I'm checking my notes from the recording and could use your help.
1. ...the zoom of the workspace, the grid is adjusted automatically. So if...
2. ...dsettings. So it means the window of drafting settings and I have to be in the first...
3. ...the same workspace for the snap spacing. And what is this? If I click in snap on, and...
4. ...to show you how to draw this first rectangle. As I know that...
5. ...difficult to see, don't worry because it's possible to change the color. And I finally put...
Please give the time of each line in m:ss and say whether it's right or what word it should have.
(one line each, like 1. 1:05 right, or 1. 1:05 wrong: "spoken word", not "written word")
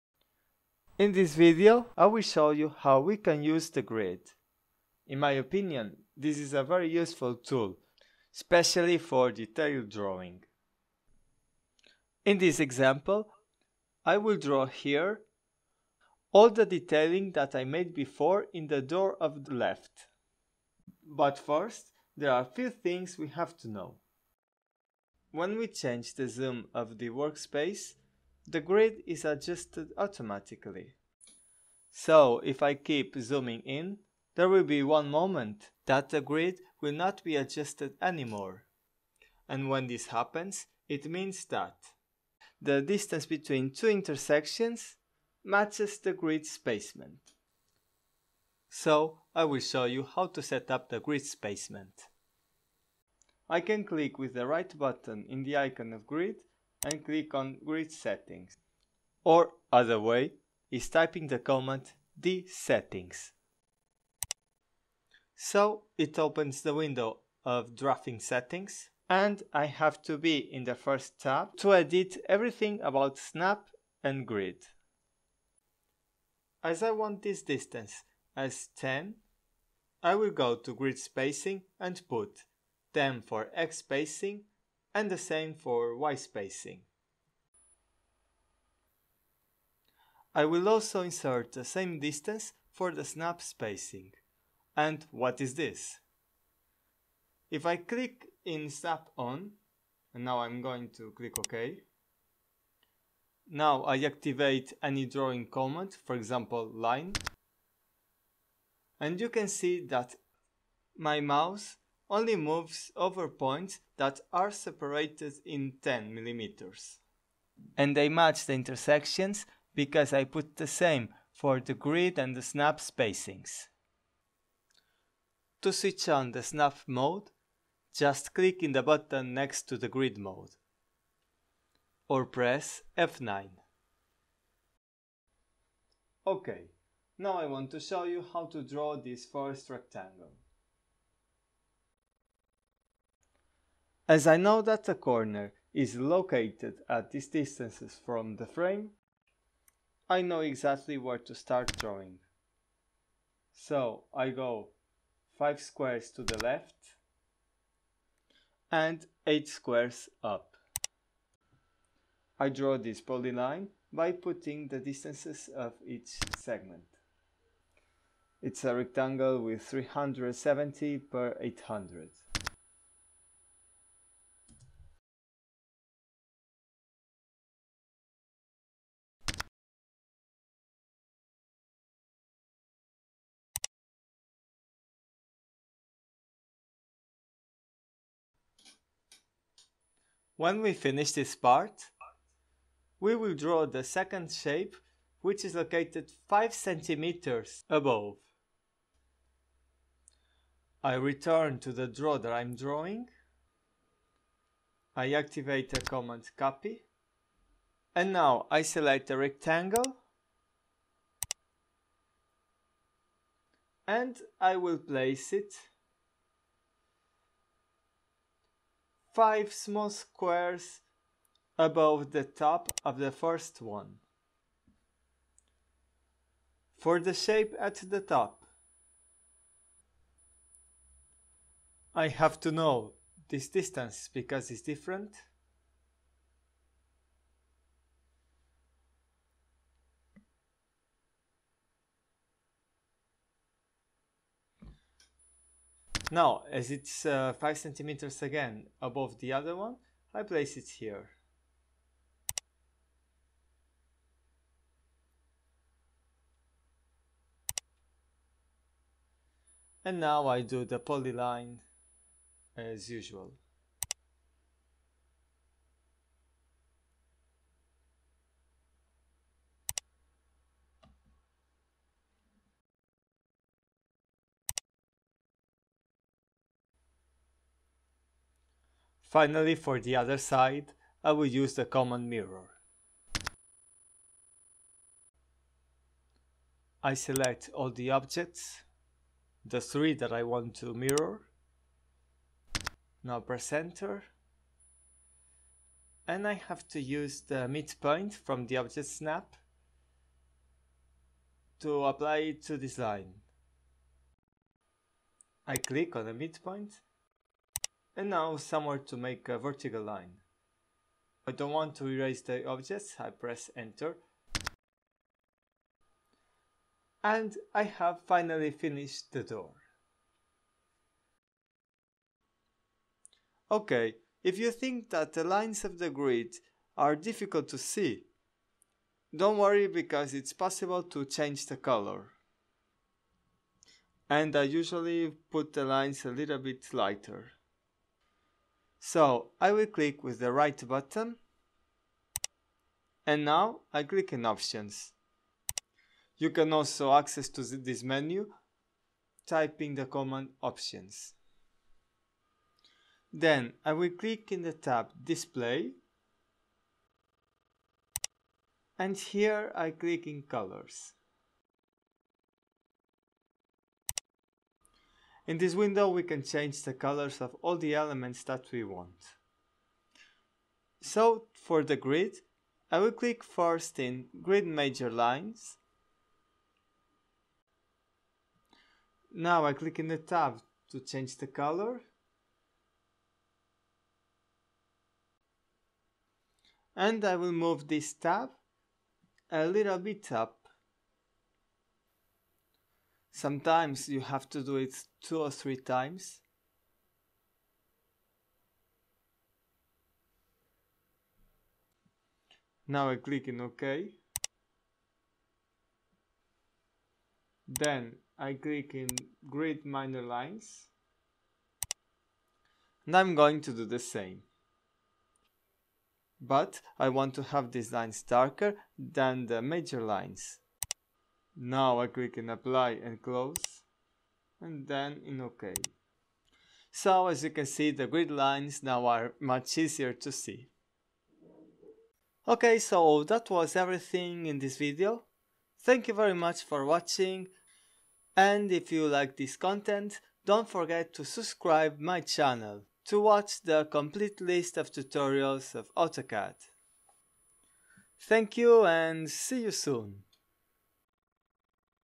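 1. 0:26 right
2. 1:02 wrong: "opens", not "means"
3. 1:31 wrong: "distance", not "workspace"
4. 2:17 right
5. 5:26 wrong: "usually", not "finally".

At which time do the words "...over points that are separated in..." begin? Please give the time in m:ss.
1:52.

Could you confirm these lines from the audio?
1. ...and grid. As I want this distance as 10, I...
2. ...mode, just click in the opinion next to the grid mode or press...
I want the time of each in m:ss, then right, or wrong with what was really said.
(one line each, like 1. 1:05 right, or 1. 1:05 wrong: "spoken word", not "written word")
1. 1:14 right
2. 2:06 wrong: "button", not "opinion".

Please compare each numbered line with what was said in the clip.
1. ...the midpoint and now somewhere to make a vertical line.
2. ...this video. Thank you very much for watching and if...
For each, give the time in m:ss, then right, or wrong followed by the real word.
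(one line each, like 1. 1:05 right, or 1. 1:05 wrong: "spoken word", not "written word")
1. 5:06 right
2. 7:14 right.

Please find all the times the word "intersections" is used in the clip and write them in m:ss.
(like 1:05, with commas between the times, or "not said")
0:43, 1:58.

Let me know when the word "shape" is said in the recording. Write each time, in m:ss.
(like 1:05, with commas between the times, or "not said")
3:14, 3:47.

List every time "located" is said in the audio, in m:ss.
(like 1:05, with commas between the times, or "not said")
2:25, 3:15.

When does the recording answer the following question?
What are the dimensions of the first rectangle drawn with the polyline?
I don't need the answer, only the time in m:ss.
2:49.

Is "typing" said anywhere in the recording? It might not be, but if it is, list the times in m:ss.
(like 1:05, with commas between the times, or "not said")
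1:00, 5:49.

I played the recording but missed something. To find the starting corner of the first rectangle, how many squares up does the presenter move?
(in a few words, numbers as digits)
8.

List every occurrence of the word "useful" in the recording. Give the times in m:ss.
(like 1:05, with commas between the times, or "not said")
0:06.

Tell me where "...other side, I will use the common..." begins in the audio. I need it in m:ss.
4:39.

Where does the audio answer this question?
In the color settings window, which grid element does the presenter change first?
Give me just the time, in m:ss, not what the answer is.
6:14.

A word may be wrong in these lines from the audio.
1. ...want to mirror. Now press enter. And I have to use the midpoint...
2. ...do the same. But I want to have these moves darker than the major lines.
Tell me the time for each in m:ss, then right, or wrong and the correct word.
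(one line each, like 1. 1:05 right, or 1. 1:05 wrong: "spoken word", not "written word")
1. 4:50 right
2. 6:53 wrong: "lines", not "moves".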